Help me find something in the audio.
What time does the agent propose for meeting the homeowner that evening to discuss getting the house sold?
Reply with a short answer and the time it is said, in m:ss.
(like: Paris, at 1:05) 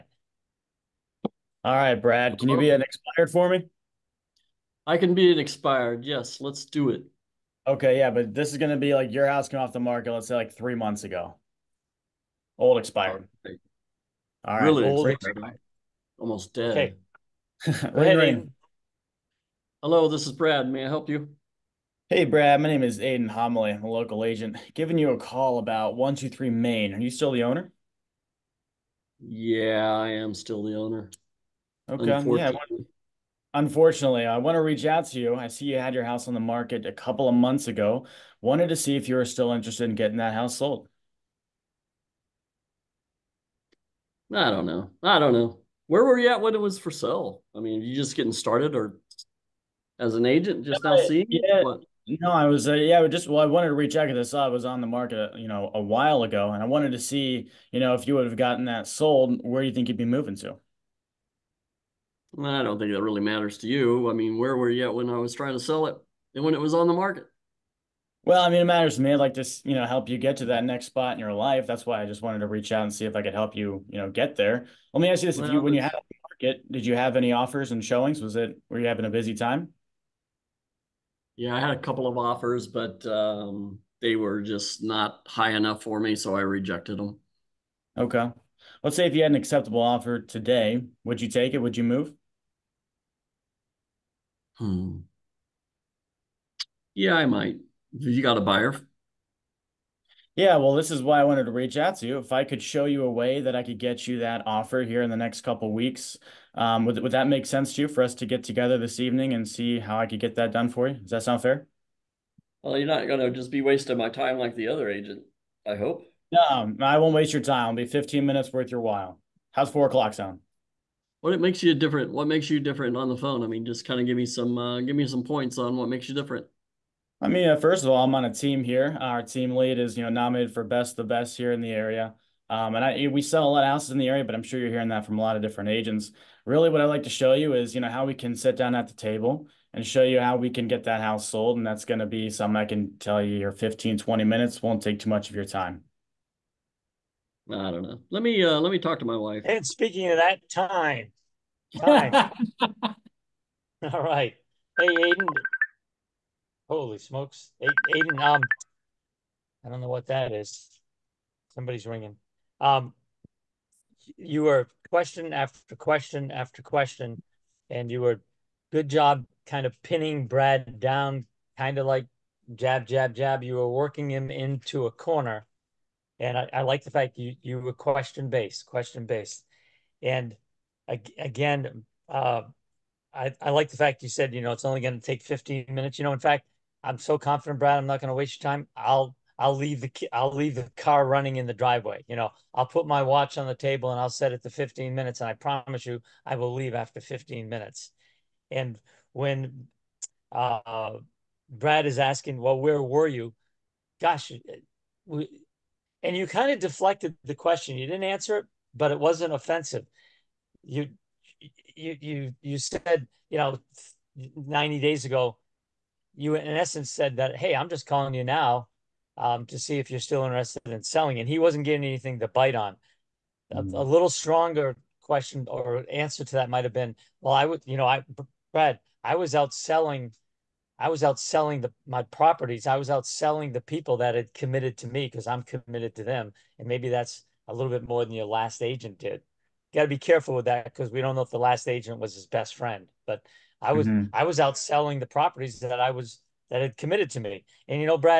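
4 o'clock, at 1:59.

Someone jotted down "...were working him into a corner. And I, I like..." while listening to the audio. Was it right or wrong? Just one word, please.
right.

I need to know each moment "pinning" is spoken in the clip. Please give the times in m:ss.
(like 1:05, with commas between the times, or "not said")
2:49.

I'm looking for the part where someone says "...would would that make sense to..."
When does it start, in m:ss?
1:46.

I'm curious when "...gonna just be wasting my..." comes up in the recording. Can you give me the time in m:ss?
1:53.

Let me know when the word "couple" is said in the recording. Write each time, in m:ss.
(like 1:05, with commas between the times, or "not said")
0:36, 1:21, 1:45.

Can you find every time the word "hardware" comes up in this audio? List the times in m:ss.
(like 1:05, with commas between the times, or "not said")
not said.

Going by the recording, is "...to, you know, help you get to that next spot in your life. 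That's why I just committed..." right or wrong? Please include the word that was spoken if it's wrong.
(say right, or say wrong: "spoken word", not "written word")
wrong: "wanted", not "committed".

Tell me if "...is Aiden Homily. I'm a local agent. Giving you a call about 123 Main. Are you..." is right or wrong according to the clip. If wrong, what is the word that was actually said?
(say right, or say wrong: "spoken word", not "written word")
right.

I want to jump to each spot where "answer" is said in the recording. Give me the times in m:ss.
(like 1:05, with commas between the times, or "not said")
3:28, 3:45.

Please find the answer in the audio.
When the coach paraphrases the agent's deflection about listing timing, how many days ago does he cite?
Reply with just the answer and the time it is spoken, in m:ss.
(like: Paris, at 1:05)
90 days, at 3:34.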